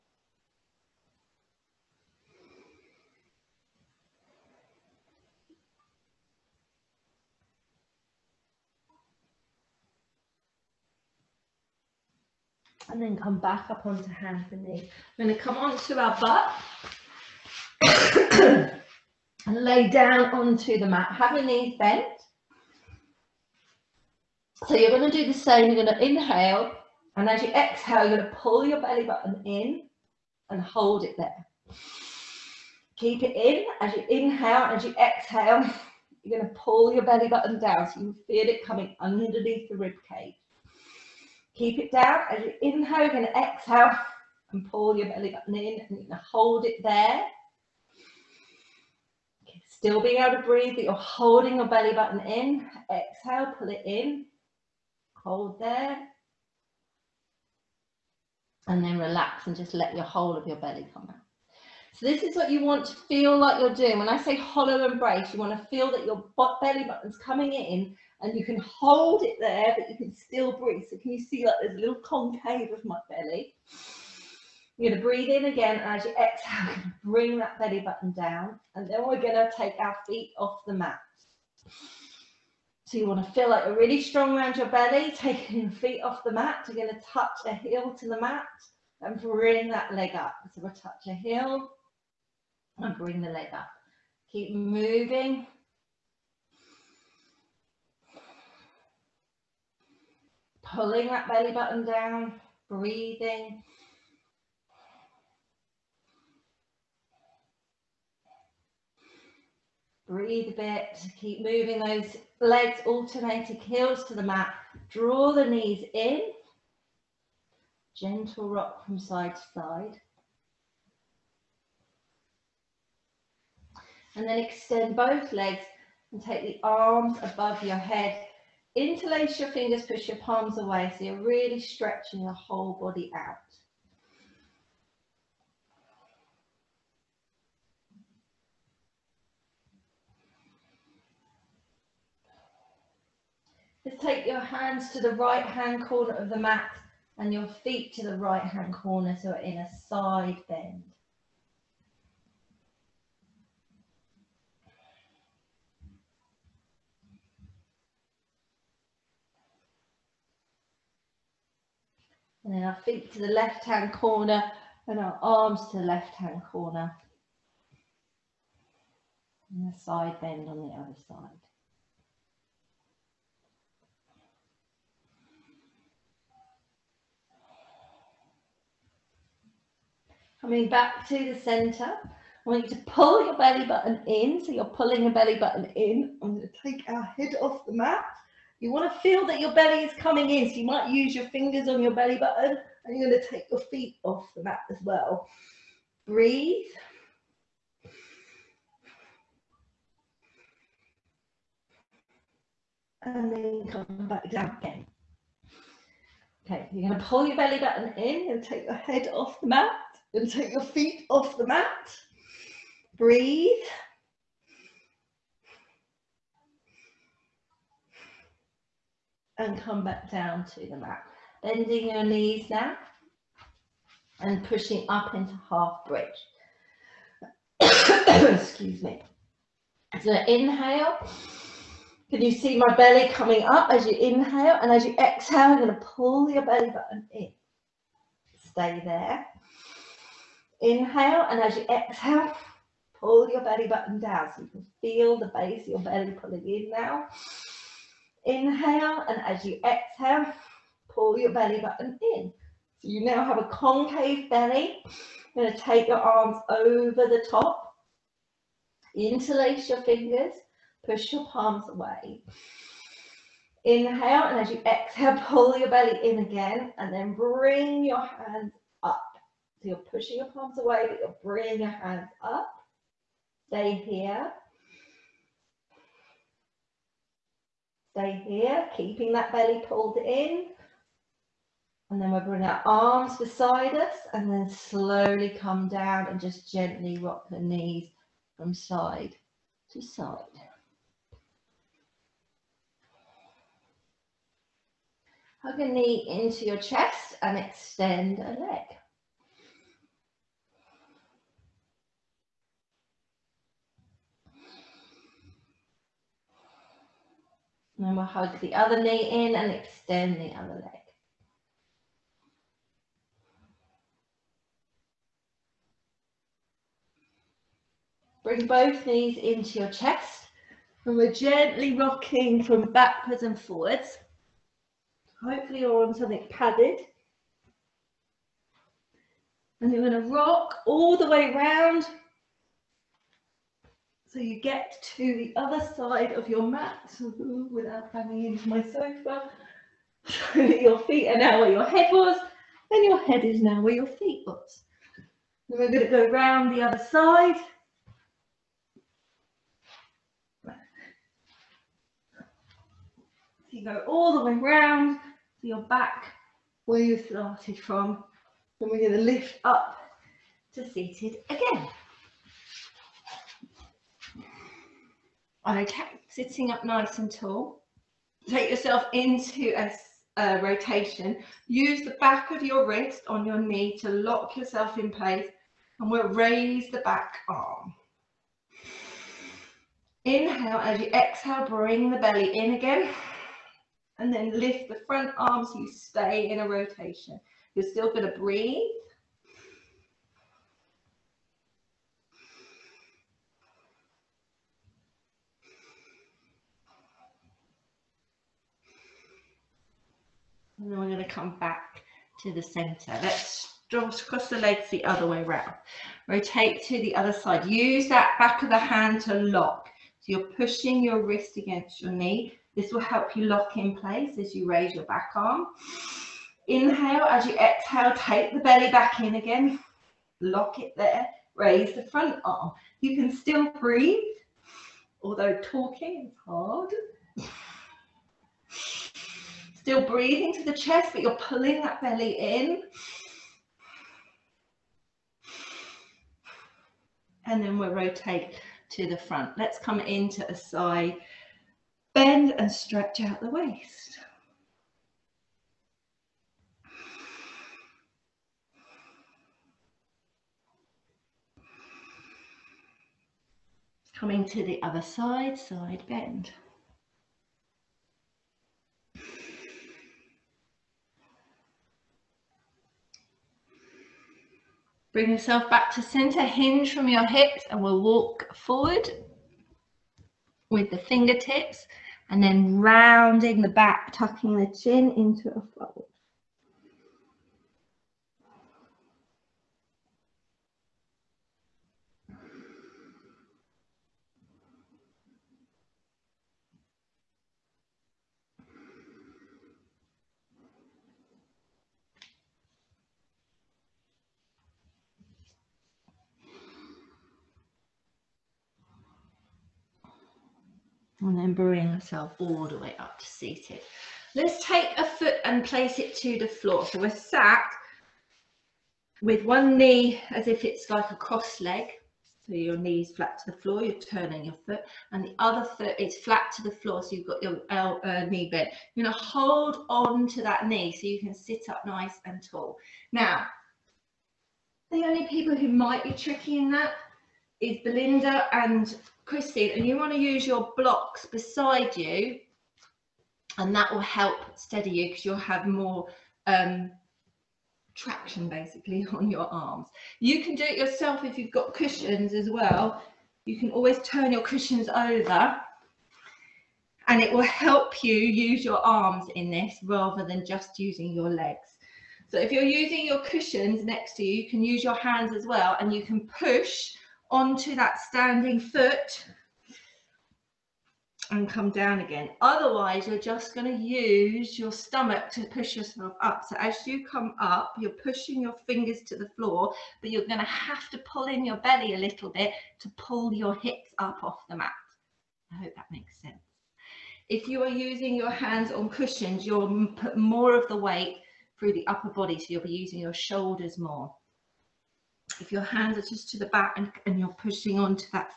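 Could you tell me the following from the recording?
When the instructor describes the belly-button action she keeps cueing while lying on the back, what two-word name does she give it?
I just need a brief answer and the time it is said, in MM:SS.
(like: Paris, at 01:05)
hollow embrace, at 01:04.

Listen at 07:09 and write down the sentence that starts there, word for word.
Still breathing to the chest, but you're pulling that belly in.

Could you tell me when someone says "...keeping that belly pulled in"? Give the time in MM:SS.
04:38.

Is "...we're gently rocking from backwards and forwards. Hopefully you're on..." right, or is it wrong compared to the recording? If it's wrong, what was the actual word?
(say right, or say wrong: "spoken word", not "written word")
right.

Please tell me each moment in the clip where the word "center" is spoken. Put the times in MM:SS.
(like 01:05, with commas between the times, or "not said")
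03:01, 06:42, 07:45.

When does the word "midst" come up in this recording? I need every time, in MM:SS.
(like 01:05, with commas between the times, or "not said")
not said.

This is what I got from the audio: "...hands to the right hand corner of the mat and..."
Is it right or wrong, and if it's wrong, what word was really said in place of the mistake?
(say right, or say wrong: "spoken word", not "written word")
right.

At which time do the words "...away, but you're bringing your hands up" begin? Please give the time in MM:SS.
04:30.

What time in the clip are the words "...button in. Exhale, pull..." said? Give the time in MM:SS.
00:51.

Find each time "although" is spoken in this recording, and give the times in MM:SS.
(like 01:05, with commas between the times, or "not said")
07:05.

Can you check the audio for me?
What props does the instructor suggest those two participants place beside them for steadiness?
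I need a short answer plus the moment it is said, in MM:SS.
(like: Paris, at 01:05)
blocks, at 08:50.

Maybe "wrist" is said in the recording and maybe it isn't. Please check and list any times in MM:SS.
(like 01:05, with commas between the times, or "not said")
06:12, 06:51.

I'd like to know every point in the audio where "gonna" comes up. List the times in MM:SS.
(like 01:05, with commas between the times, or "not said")
08:38.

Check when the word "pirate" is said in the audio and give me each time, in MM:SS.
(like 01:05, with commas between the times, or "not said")
not said.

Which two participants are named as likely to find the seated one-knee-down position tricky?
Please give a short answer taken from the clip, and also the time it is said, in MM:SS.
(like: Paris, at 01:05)
Belinda and Christine, at 08:47.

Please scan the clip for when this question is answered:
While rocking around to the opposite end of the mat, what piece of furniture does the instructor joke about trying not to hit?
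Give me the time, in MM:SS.
05:38.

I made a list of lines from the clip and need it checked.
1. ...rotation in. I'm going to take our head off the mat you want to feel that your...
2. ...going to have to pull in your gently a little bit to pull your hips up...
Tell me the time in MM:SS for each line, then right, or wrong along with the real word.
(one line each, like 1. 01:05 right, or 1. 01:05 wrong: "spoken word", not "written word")
1. 03:05 wrong: "button", not "rotation"
2. 09:30 wrong: "belly", not "gently".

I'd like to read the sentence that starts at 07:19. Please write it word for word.
Let's come into a side bend and stretch out the waist.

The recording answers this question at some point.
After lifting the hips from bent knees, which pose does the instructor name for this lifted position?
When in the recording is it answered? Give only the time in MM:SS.
03:45.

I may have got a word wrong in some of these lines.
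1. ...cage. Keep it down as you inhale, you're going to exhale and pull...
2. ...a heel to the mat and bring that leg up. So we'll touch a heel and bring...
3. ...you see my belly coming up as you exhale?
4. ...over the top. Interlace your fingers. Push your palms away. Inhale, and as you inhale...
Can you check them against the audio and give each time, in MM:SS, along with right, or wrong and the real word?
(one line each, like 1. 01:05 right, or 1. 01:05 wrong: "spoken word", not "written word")
1. 00:40 right
2. 01:27 right
3. 03:52 wrong: "inhale", not "exhale"
4. 04:16 wrong: "exhale", not "inhale".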